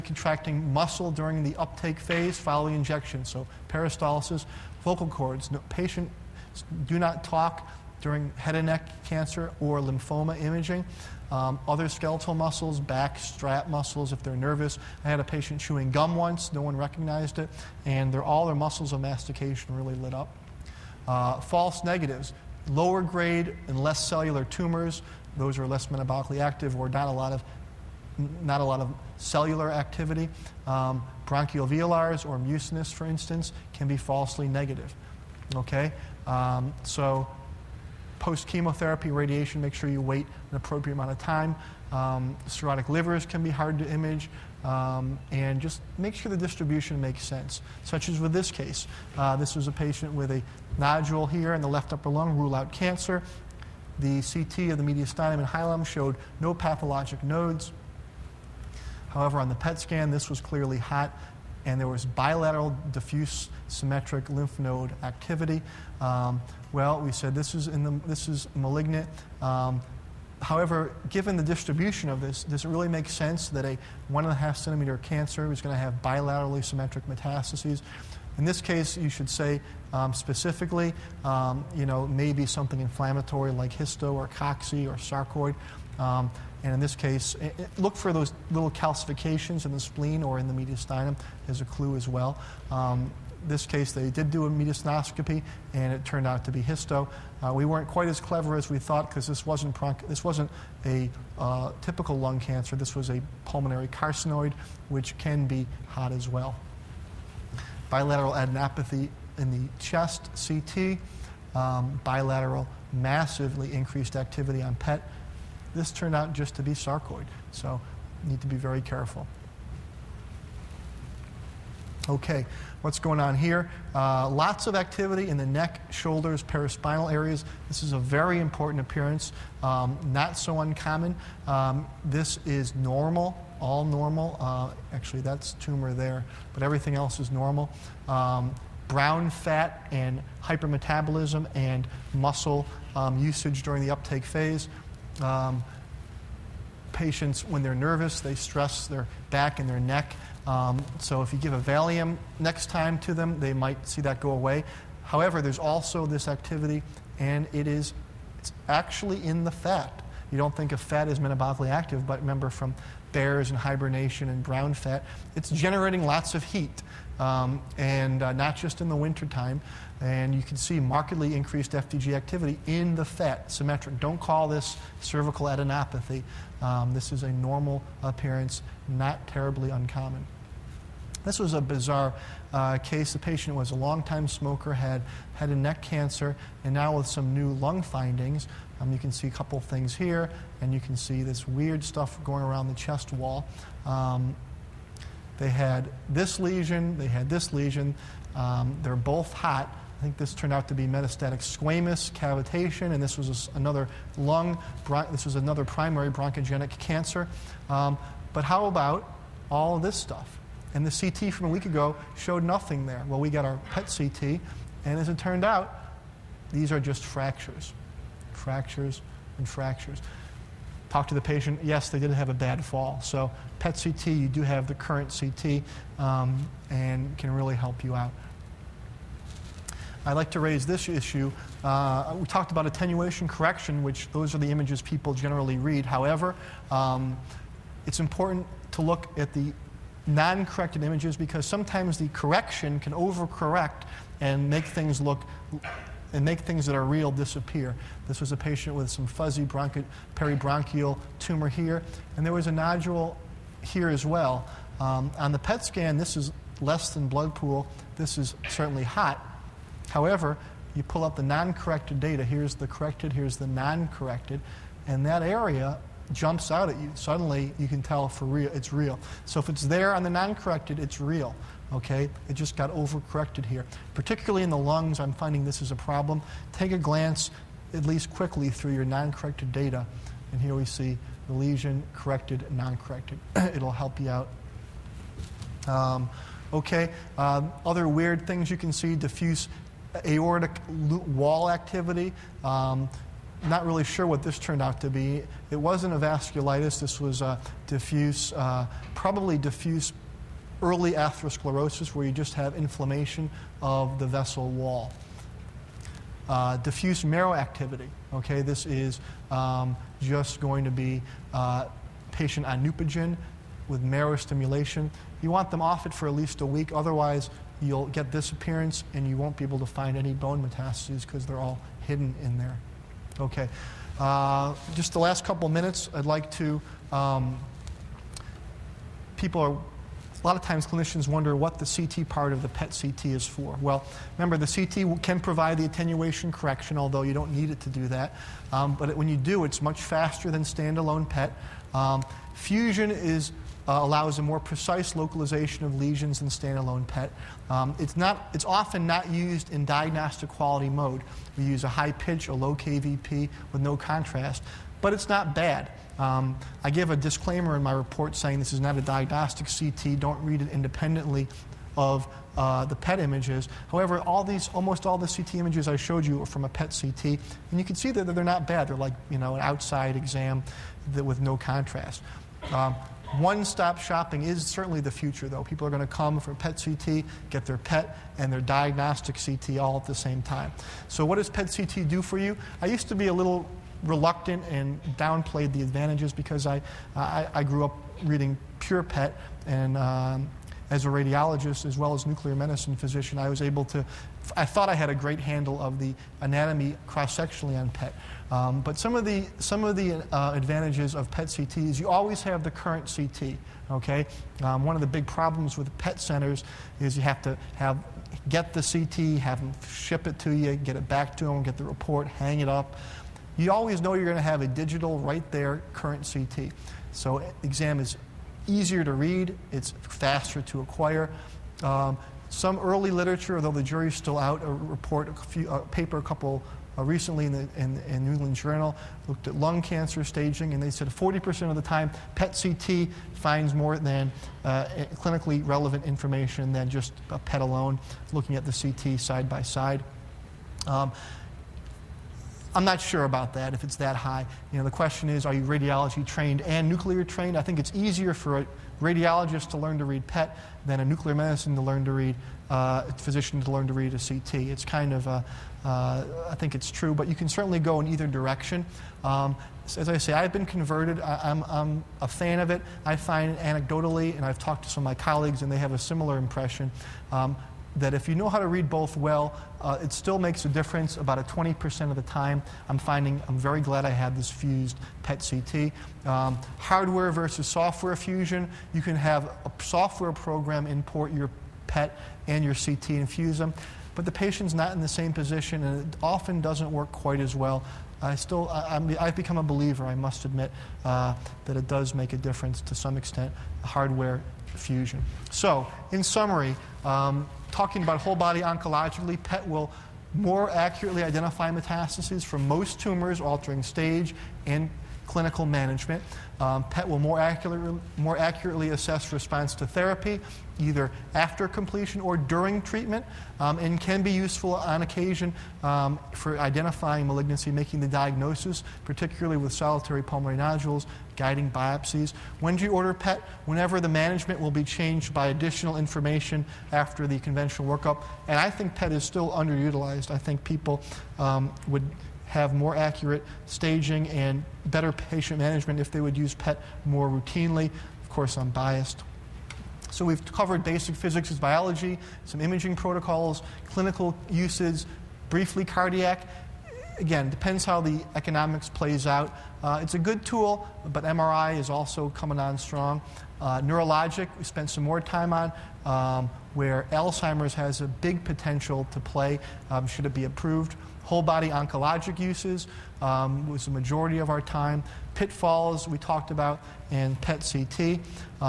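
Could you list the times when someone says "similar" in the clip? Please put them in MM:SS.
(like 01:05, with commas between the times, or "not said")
07:45.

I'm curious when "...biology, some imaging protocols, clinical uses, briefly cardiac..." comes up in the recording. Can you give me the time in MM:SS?
09:01.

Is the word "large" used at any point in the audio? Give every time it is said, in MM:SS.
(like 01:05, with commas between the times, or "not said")
not said.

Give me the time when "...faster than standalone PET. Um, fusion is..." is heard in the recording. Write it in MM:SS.
05:39.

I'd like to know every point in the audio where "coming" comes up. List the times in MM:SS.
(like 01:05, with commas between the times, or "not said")
09:12.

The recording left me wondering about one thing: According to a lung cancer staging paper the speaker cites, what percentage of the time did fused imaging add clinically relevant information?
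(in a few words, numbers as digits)
40%.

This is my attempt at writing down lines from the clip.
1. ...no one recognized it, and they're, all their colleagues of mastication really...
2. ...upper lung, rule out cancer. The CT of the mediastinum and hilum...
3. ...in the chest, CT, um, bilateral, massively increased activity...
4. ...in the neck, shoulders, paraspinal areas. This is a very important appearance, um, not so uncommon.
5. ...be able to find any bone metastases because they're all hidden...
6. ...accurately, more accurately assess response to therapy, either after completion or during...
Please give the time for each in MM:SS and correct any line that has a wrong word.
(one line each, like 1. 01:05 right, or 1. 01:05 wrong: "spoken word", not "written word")
1. 00:16 wrong: "muscles", not "colleagues"
2. 00:51 right
3. 01:49 right
4. 02:05 right
5. 05:19 right
6. 08:27 right.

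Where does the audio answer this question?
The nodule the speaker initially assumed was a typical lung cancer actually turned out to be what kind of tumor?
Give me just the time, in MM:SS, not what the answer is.
01:43.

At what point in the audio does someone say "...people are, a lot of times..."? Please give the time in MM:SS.
05:29.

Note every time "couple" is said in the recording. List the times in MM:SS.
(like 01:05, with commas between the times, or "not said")
03:09, 05:25, 07:06.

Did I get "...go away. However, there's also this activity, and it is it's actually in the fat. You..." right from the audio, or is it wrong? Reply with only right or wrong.
right.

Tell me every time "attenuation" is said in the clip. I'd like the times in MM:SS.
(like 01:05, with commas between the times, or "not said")
03:52, 05:35.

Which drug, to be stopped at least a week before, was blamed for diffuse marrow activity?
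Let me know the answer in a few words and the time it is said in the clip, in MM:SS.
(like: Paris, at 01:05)
Neupogen, at 05:12.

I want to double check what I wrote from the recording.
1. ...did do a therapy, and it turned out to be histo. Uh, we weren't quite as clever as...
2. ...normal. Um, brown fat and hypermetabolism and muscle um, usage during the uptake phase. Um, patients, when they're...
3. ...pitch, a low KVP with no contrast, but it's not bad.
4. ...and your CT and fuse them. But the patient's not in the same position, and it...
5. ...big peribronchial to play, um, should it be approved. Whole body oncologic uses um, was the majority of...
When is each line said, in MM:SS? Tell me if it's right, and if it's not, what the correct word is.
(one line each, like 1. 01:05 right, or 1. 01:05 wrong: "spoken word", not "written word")
1. 01:34 wrong: "mediastinoscopy", not "therapy"
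2. 02:17 right
3. 05:51 right
4. 08:02 right
5. 09:17 wrong: "potential", not "peribronchial".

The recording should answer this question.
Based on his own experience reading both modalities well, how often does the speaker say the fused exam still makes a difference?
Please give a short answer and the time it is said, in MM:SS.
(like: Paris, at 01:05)
About 20%, at 07:50.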